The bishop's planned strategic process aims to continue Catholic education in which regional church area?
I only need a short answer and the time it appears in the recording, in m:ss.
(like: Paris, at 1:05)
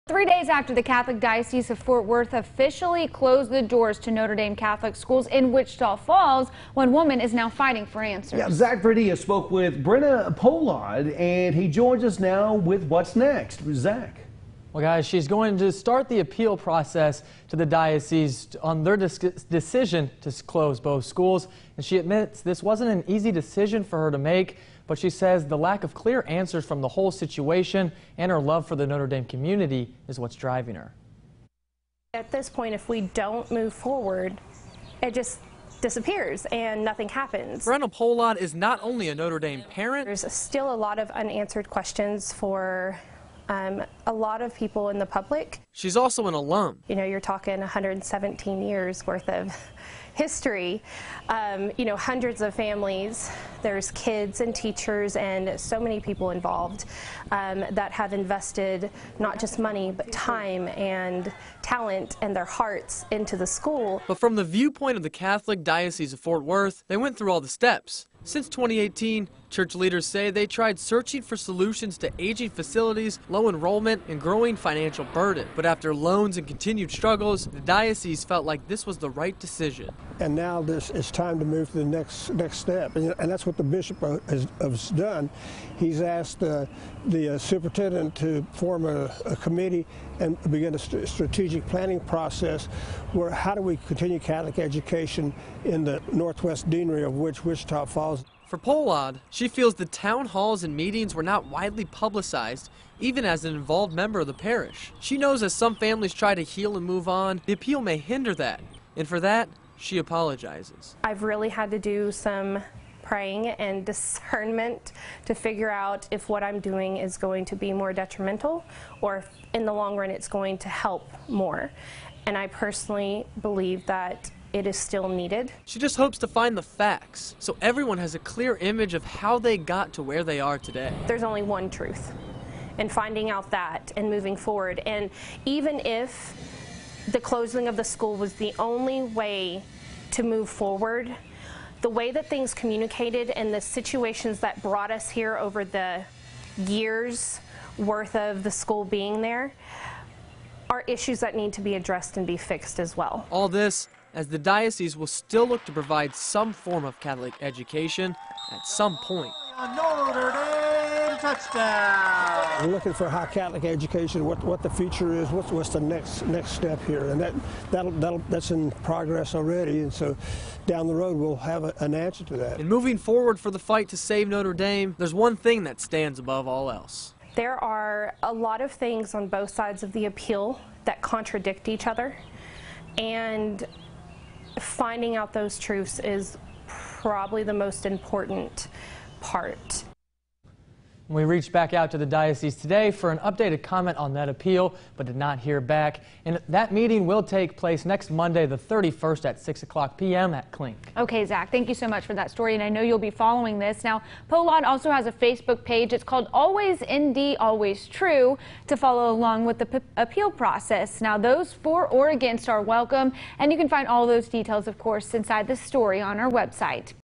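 Northwest Deanery, at 1:36.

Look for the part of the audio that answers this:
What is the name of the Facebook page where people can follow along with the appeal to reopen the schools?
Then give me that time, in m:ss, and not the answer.
3:26.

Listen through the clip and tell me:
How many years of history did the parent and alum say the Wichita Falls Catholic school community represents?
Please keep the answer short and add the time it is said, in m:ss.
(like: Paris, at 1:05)
117, at 0:47.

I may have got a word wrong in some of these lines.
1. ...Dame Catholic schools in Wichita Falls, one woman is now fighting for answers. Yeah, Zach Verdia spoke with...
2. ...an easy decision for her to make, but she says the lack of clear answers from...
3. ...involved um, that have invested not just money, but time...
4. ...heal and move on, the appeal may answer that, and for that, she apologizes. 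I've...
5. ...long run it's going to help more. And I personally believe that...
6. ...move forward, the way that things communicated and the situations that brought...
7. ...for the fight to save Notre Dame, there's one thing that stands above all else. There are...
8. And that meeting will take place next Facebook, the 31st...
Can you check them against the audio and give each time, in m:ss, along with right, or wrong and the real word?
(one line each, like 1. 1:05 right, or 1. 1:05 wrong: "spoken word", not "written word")
1. 0:04 right
2. 0:22 right
3. 0:56 right
4. 1:46 wrong: "hinder", not "answer"
5. 1:59 right
6. 2:20 right
7. 2:53 right
8. 3:16 wrong: "Monday", not "Facebook".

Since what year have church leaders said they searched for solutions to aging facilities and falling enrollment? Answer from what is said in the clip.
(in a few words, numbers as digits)
2018.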